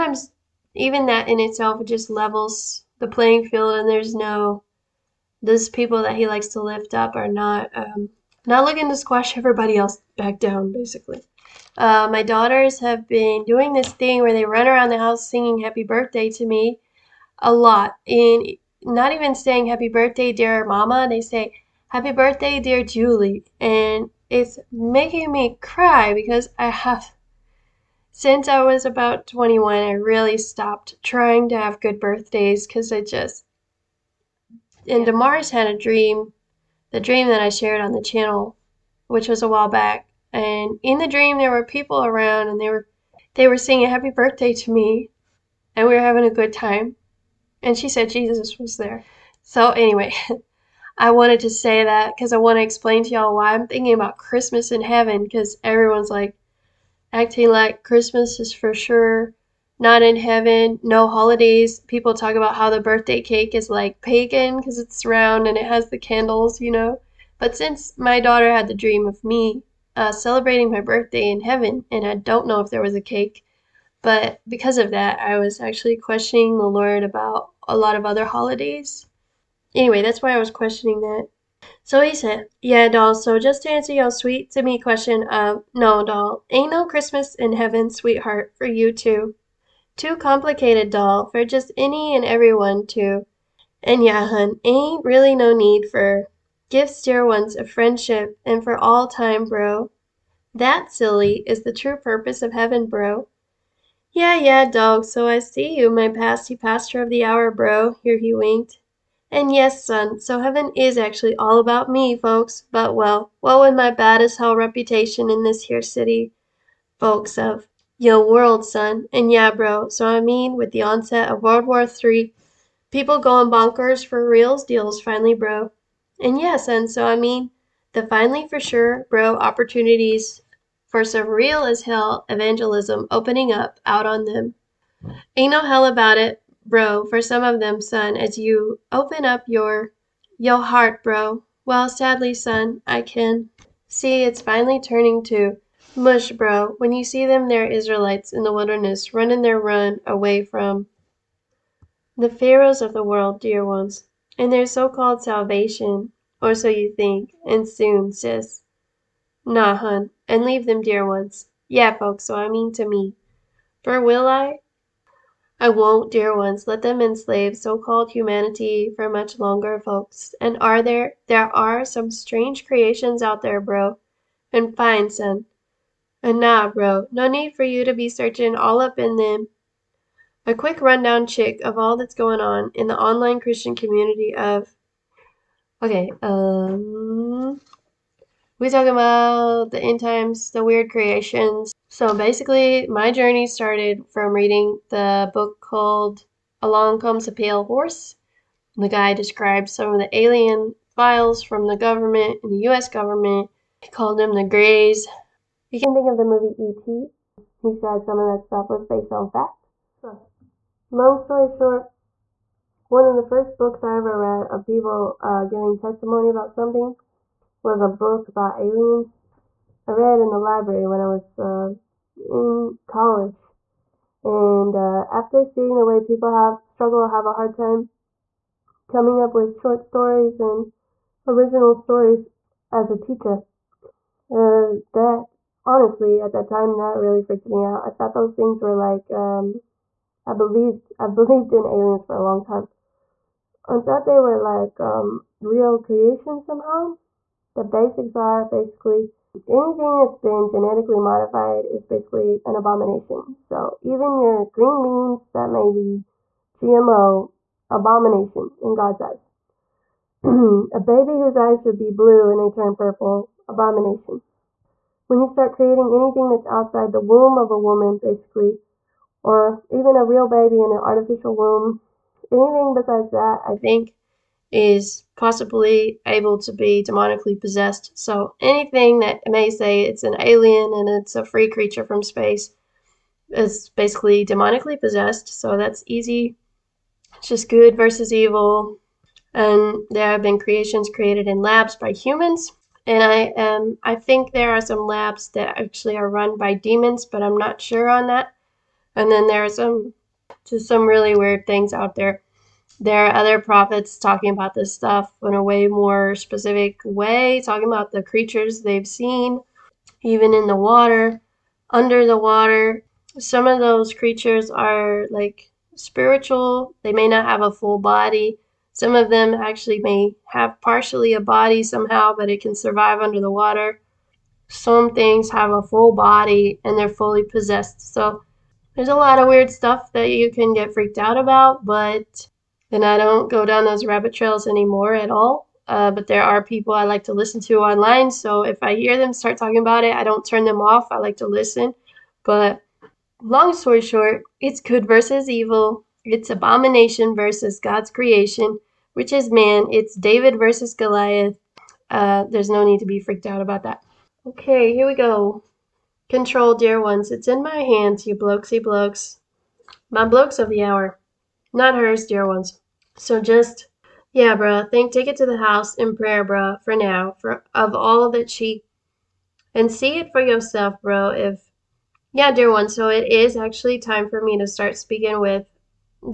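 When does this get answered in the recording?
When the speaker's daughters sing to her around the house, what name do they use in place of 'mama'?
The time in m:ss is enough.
0:22.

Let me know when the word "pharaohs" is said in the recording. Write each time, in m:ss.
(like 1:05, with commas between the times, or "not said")
2:32.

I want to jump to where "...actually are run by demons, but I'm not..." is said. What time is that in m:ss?
4:55.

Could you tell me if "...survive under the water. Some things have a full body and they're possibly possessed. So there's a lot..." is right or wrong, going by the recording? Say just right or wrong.
wrong.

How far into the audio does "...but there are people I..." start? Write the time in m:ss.
5:35.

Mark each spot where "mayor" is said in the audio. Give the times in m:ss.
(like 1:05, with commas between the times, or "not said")
not said.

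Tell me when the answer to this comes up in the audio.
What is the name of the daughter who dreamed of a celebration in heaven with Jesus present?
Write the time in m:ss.
0:35.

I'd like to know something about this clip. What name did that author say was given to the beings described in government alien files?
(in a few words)
the Greys.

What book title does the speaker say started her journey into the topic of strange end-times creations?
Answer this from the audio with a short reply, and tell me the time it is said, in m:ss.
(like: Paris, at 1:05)
Along Comes a Pale Horse, at 3:16.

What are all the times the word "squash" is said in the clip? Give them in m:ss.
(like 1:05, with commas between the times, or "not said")
0:08.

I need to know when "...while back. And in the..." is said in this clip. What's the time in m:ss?
0:39.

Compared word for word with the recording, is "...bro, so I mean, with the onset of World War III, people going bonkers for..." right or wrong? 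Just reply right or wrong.
right.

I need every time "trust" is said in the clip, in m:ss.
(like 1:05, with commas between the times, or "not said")
not said.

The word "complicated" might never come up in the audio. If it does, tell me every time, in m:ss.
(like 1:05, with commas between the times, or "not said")
1:30.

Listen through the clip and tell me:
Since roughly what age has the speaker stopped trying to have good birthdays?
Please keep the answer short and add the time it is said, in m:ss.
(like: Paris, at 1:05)
21, at 0:29.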